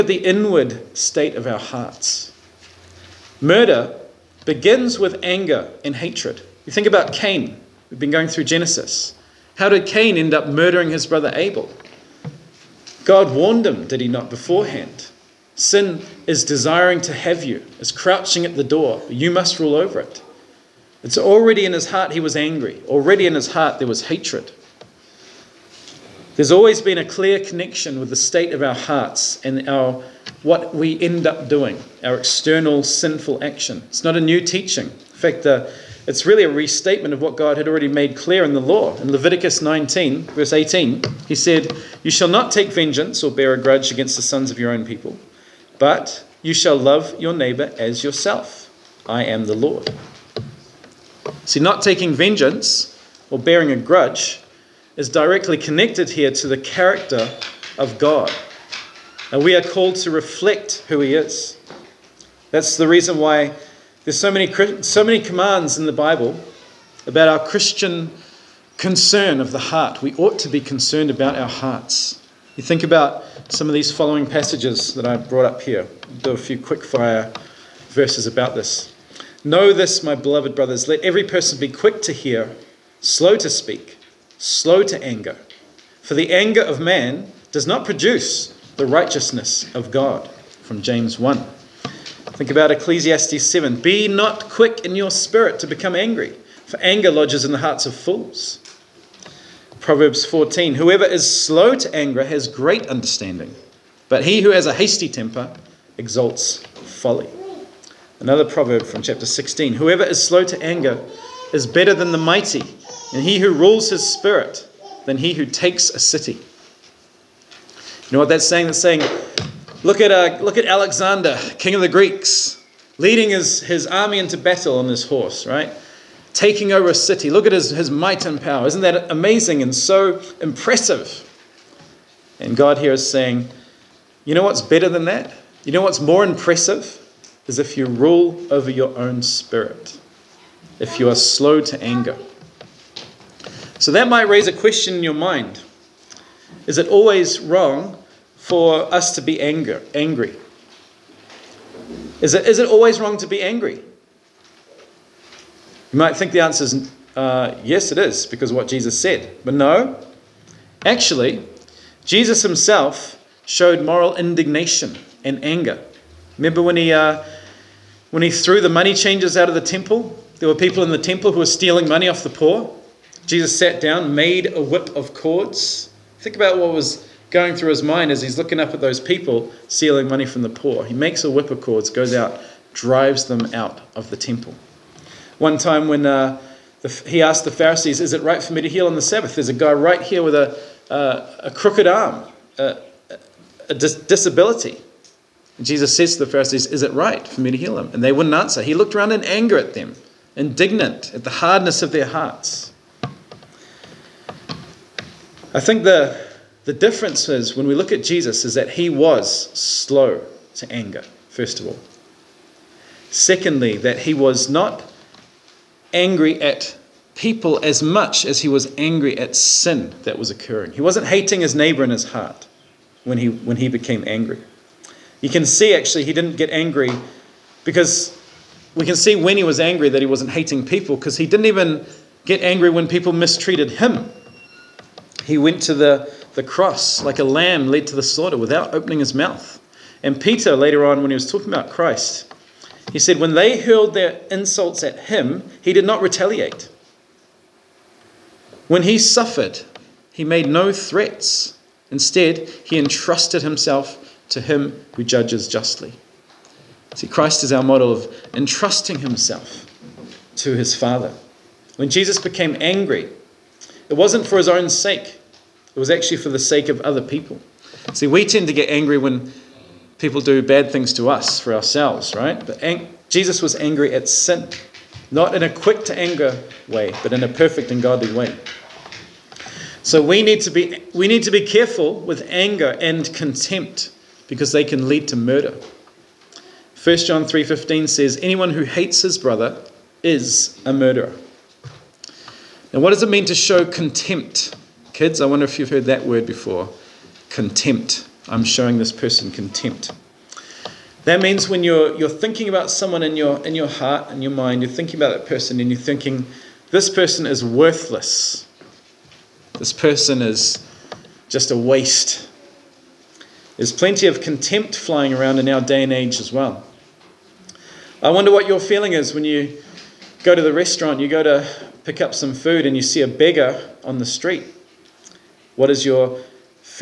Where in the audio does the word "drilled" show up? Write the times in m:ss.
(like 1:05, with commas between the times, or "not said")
not said.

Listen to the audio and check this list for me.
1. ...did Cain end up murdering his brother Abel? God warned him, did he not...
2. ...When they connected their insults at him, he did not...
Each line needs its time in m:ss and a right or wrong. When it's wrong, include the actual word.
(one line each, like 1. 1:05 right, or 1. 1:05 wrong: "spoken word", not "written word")
1. 0:09 right
2. 4:03 wrong: "hurled", not "connected".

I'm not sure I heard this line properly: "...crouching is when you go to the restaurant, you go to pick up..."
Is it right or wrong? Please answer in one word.
wrong.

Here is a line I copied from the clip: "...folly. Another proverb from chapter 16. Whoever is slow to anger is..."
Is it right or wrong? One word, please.
right.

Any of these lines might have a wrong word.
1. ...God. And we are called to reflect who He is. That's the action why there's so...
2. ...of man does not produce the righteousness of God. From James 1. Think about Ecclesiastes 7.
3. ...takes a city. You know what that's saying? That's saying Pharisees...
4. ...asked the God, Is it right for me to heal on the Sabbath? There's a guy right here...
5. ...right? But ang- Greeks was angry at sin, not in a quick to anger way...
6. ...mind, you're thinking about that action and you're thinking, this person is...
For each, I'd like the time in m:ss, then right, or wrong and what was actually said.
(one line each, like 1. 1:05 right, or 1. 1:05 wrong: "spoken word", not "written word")
1. 0:57 wrong: "reason", not "action"
2. 1:26 right
3. 1:55 wrong: "Look", not "Pharisees"
4. 3:07 wrong: "Pharisees", not "God"
5. 4:32 wrong: "Jesus", not "Greeks"
6. 5:04 wrong: "person", not "action".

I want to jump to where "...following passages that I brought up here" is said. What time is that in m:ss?
1:13.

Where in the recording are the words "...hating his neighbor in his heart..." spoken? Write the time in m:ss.
3:41.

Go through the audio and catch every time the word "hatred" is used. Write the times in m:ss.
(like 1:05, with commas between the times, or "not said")
0:05, 0:24.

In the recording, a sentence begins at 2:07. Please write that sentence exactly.
Look at his, his might and power.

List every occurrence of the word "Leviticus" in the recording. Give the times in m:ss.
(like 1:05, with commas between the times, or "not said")
0:39.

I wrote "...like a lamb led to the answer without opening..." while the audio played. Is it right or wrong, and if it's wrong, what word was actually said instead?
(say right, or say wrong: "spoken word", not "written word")
wrong: "slaughter", not "answer".